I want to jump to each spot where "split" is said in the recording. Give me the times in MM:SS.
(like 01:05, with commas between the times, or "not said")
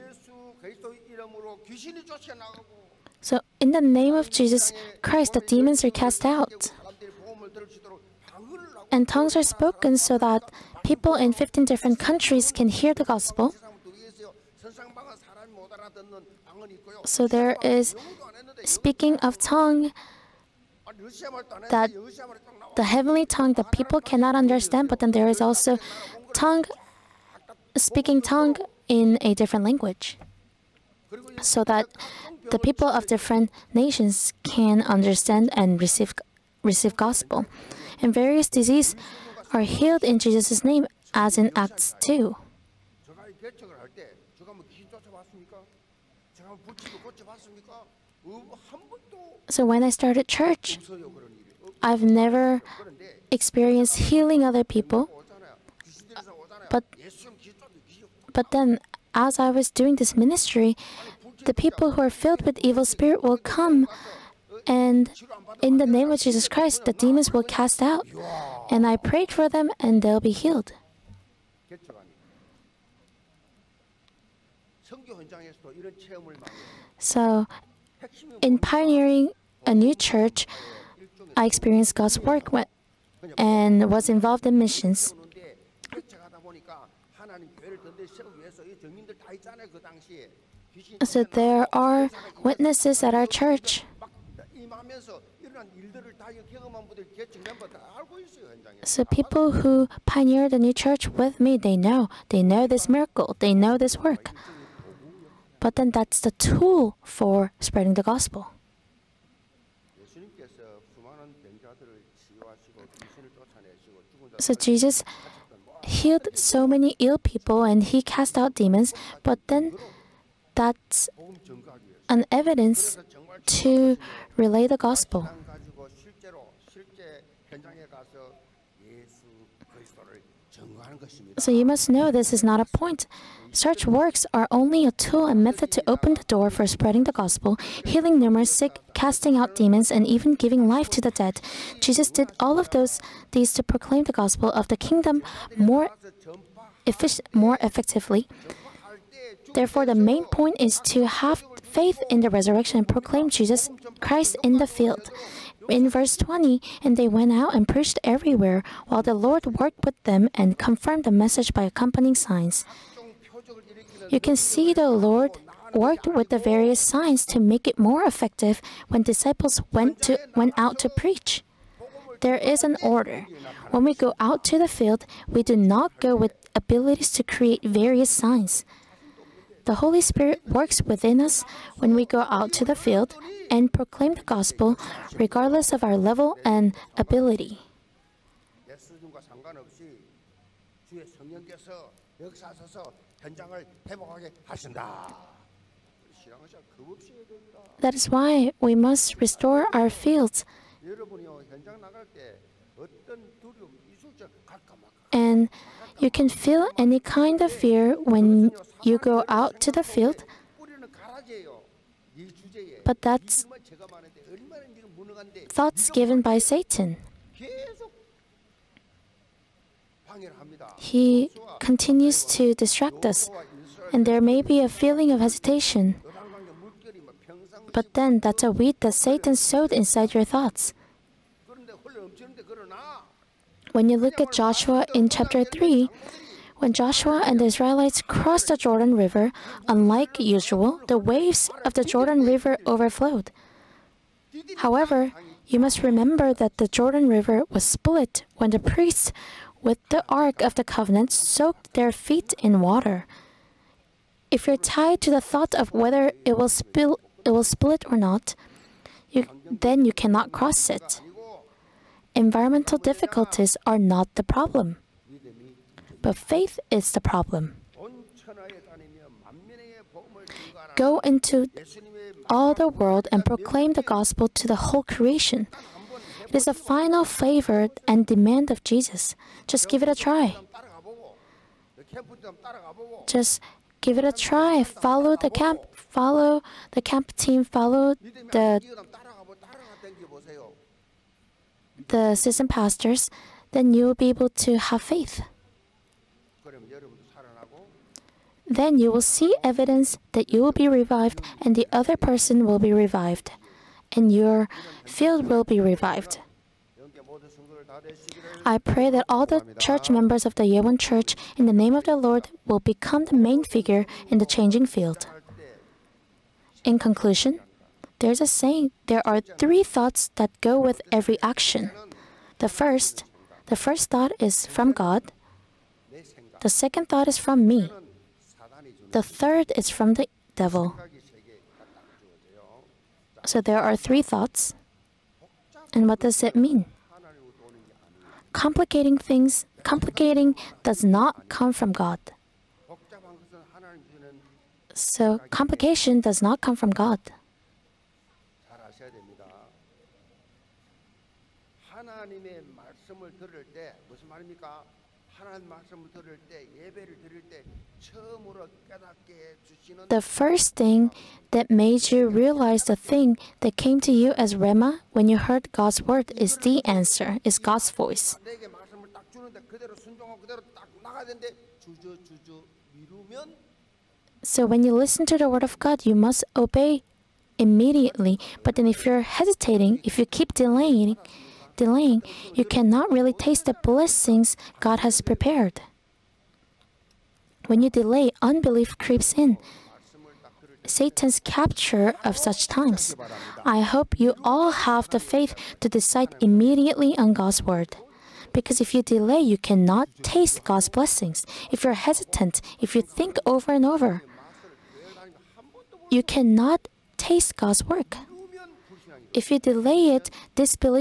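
04:07, 04:17.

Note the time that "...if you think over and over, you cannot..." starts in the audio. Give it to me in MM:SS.
06:42.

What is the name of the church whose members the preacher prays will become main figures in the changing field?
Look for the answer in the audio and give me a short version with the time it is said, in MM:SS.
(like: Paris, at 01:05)
Yewon Church, at 05:10.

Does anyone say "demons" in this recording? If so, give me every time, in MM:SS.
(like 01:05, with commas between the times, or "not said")
00:05, 01:06, 01:58, 02:19.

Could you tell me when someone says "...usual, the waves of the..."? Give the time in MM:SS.
04:00.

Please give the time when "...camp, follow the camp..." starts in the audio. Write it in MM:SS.
04:45.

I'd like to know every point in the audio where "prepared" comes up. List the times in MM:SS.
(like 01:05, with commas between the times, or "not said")
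06:25.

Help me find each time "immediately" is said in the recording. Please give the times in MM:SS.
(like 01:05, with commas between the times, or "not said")
06:17, 06:36.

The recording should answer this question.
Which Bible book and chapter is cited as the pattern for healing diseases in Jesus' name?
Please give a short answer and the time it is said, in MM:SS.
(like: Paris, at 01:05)
Acts 2, at 00:41.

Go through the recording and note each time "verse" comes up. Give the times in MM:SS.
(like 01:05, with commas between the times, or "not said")
02:35.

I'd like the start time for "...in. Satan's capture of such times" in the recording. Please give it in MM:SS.
06:29.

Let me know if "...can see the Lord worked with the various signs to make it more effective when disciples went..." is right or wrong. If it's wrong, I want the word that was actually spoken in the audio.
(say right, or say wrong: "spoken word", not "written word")
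right.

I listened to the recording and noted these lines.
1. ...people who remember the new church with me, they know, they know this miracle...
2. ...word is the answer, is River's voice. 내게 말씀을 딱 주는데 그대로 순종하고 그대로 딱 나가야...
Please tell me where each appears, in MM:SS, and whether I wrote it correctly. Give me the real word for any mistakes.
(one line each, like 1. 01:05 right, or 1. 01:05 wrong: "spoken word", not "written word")
1. 01:39 wrong: "pioneer", not "remember"
2. 06:05 wrong: "God", not "River".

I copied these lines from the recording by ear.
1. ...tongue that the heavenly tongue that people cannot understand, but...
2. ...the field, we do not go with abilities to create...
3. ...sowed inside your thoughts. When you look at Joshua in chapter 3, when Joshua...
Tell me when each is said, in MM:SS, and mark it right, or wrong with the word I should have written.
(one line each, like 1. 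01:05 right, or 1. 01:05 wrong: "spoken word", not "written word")
1. 00:19 right
2. 02:54 right
3. 03:49 right.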